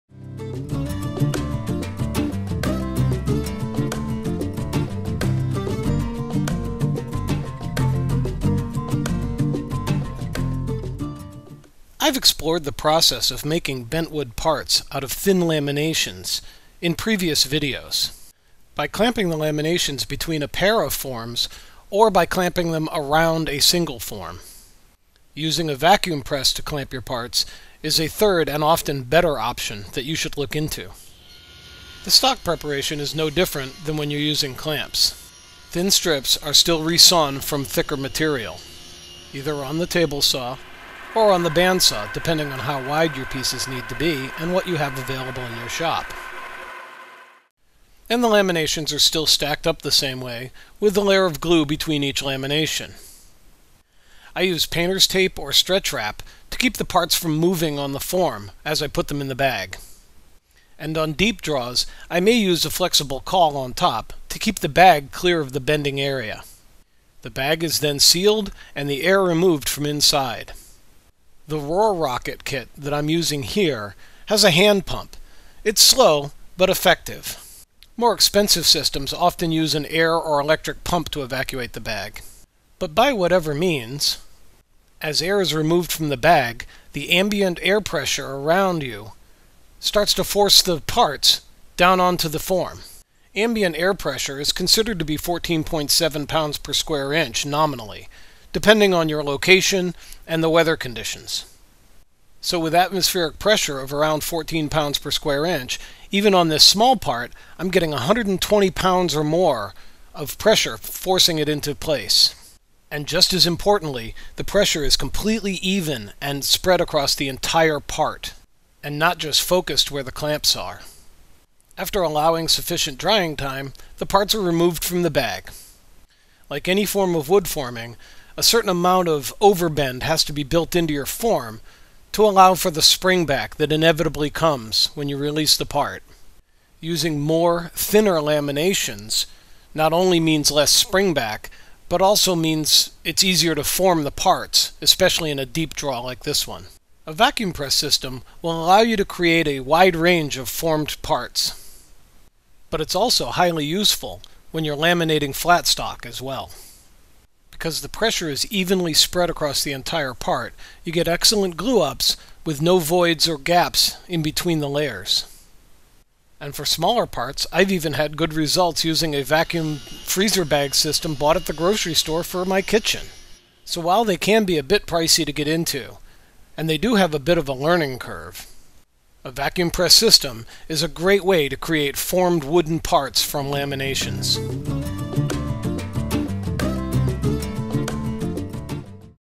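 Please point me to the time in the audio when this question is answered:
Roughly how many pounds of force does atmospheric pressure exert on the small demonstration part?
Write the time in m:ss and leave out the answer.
1:47.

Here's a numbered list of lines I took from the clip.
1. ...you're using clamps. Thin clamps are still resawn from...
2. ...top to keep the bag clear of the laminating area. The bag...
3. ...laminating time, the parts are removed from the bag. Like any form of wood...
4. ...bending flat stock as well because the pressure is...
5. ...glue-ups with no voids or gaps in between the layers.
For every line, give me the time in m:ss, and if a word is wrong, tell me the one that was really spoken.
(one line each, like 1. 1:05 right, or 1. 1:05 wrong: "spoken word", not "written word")
1. 0:34 wrong: "strips", not "clamps"
2. 1:03 wrong: "bending", not "laminating"
3. 2:02 wrong: "drying", not "laminating"
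4. 2:34 wrong: "laminating", not "bending"
5. 2:41 right.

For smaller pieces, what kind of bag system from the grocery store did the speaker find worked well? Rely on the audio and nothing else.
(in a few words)
vacuum freezer bag.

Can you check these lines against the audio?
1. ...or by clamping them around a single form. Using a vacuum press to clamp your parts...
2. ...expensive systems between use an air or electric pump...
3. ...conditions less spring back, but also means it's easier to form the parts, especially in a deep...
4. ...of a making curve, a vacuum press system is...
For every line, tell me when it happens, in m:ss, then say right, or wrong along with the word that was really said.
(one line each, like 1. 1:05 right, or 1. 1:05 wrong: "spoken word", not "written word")
1. 0:21 right
2. 1:18 wrong: "often", not "between"
3. 2:20 wrong: "means", not "conditions"
4. 2:57 wrong: "learning", not "making".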